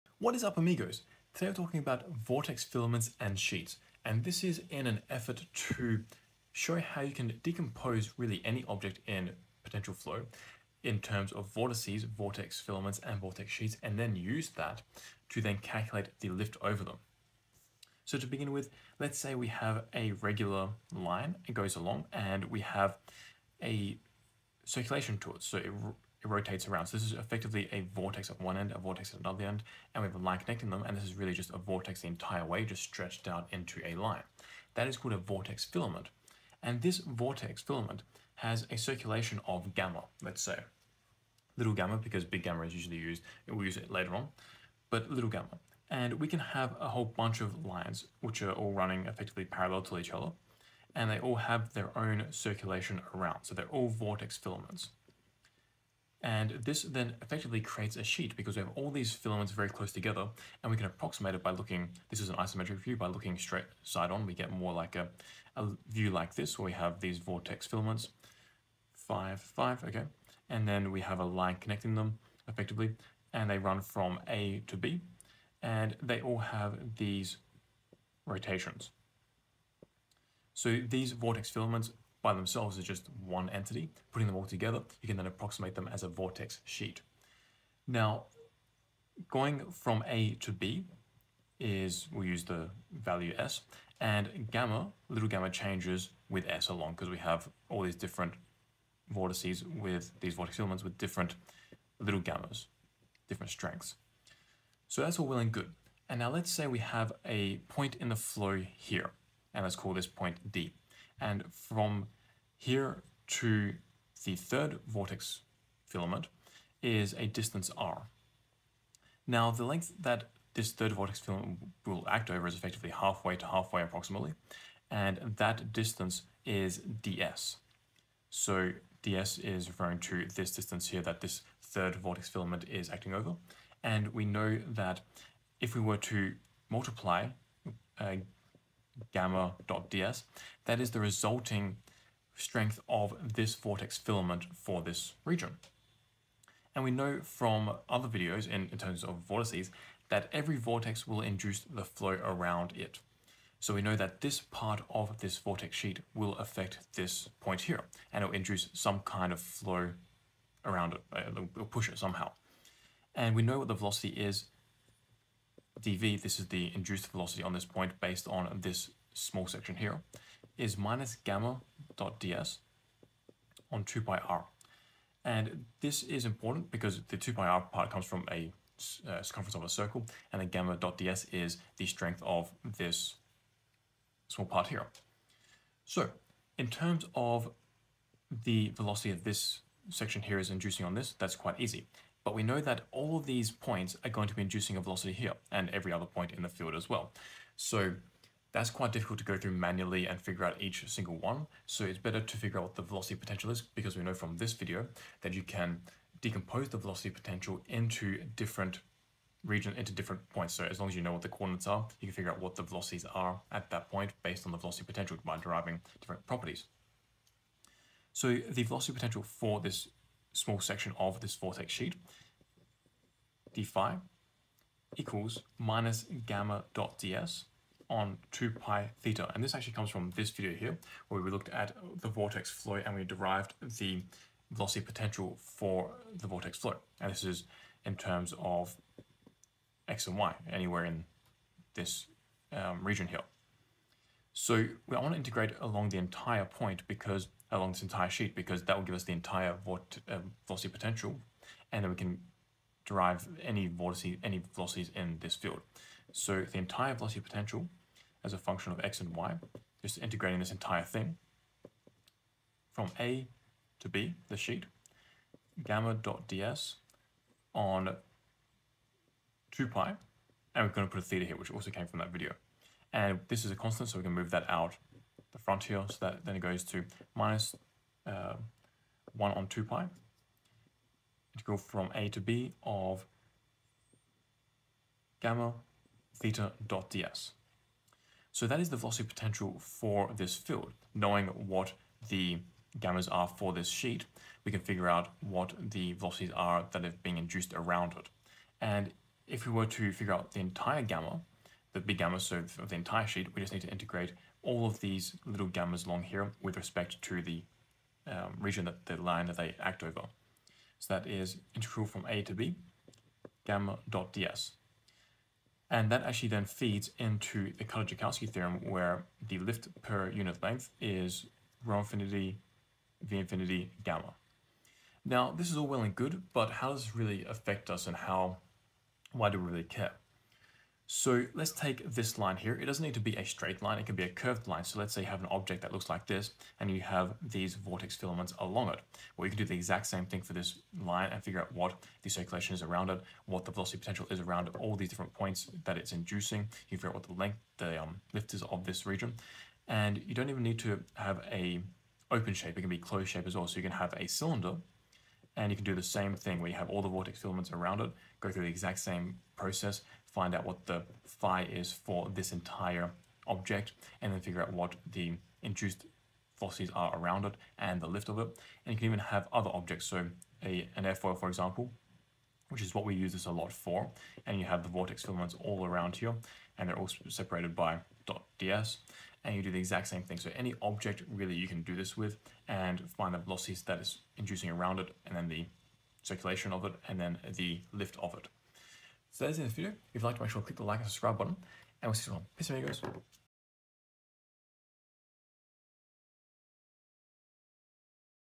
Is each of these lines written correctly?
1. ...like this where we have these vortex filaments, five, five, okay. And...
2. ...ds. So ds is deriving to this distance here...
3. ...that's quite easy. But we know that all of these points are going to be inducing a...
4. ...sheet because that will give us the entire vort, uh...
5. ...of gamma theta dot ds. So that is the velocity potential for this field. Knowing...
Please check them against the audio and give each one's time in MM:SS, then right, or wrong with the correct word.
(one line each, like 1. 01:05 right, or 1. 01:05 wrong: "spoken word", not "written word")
1. 01:06 right
2. 02:06 wrong: "referring", not "deriving"
3. 03:11 right
4. 04:08 right
5. 04:42 right.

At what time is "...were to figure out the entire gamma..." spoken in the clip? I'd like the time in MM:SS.
04:59.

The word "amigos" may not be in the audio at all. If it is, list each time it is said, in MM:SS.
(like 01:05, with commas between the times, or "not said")
00:00, 06:32.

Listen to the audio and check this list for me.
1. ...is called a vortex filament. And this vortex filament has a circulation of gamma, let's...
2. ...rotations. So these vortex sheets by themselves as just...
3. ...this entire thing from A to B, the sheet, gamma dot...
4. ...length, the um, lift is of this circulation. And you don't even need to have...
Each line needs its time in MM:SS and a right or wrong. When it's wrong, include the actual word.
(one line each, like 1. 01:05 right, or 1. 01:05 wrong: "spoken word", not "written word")
1. 00:34 right
2. 01:18 wrong: "filaments", not "sheets"
3. 04:20 right
4. 05:47 wrong: "region", not "circulation".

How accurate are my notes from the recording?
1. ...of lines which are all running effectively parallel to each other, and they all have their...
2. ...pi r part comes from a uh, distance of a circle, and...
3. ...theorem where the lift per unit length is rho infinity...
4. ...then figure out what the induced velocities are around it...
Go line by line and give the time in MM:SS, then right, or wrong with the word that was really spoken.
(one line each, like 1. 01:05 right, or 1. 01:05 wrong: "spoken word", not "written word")
1. 00:47 right
2. 02:57 wrong: "circumference", not "distance"
3. 05:18 right
4. 06:04 right.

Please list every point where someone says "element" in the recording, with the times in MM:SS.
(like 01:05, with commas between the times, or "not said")
not said.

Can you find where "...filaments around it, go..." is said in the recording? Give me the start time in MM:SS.
05:57.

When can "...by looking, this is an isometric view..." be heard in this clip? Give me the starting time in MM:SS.
01:01.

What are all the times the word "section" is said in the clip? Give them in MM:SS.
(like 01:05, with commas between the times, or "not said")
02:49, 03:09, 03:40.